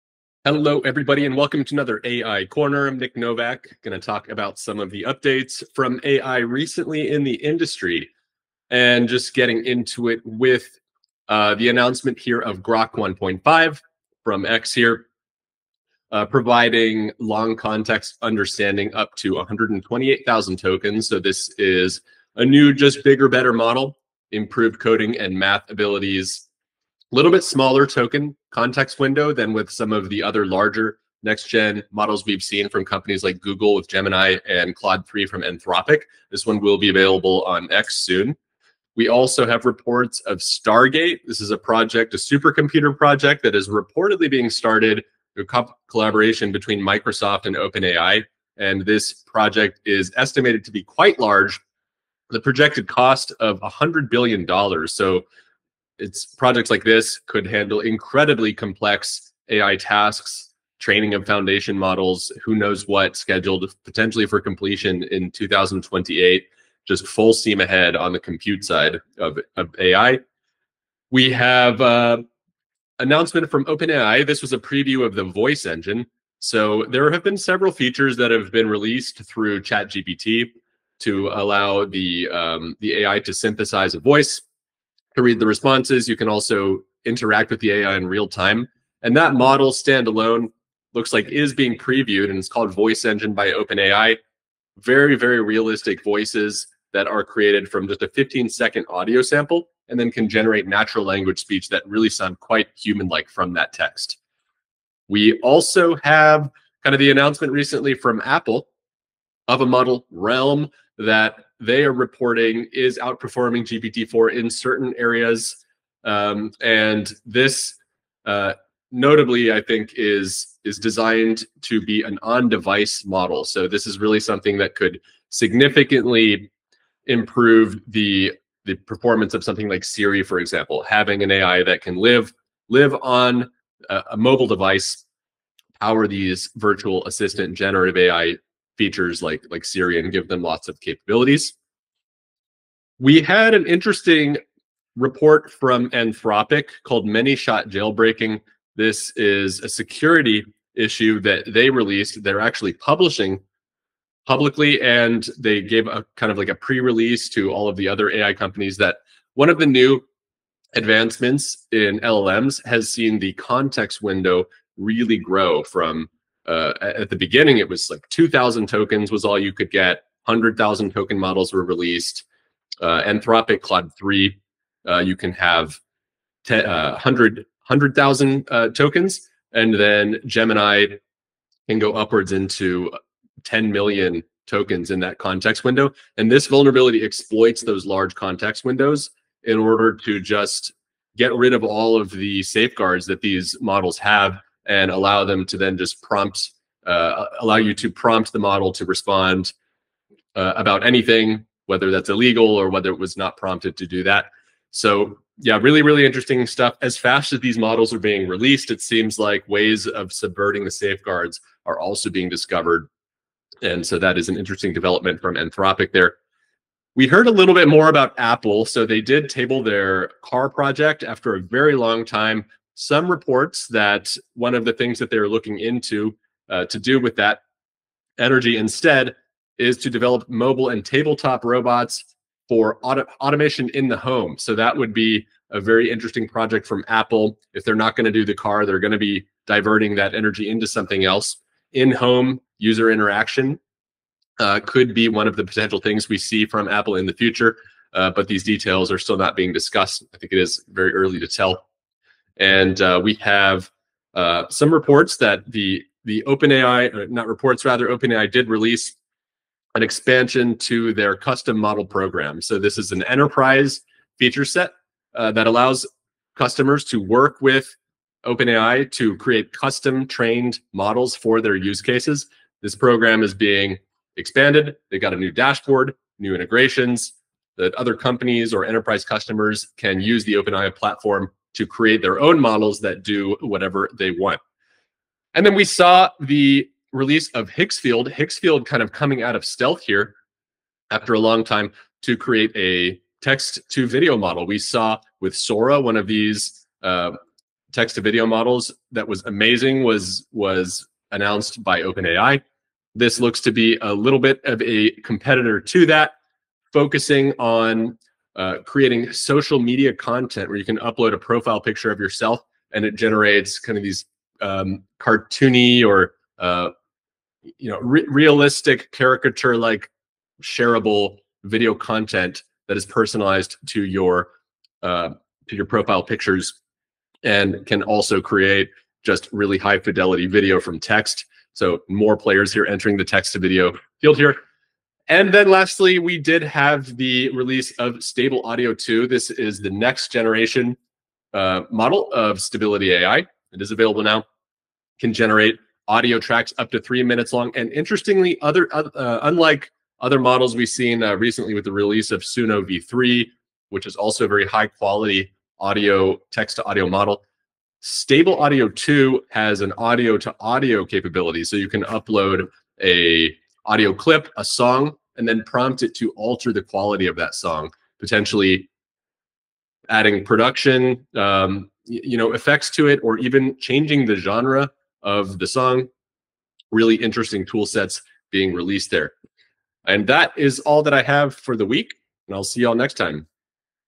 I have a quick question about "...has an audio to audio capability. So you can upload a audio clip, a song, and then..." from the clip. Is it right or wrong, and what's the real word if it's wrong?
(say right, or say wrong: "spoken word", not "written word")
right.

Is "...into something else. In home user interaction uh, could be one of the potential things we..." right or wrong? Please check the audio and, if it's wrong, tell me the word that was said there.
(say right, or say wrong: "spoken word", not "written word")
right.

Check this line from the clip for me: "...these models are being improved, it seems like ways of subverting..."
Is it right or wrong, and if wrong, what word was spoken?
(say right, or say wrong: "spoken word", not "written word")
wrong: "released", not "improved".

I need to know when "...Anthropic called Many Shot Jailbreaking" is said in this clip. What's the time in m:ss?
2:25.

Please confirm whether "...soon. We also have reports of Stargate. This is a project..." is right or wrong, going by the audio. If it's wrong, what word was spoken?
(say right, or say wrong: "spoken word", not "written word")
right.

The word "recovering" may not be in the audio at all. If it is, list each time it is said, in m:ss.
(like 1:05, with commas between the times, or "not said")
not said.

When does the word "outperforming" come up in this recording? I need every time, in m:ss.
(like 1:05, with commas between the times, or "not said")
1:52.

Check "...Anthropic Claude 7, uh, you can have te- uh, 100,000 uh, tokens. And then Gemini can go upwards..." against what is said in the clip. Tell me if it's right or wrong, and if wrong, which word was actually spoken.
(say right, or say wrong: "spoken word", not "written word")
wrong: "3", not "7".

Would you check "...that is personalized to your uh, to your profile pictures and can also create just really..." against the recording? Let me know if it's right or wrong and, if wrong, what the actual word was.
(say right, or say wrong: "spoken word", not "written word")
right.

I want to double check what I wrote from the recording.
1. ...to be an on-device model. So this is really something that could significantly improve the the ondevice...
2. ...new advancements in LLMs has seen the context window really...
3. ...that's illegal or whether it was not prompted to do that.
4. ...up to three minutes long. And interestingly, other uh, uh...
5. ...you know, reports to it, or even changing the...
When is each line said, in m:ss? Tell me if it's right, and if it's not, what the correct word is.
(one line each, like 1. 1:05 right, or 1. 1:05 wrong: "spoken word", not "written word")
1. 2:01 wrong: "performance", not "ondevice"
2. 2:39 right
3. 3:21 right
4. 5:46 right
5. 6:11 wrong: "effects", not "reports".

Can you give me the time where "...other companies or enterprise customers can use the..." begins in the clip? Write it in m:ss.
4:37.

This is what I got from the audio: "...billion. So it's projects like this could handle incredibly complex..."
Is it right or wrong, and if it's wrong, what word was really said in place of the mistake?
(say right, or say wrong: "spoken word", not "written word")
right.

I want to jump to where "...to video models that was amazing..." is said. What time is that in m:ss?
4:57.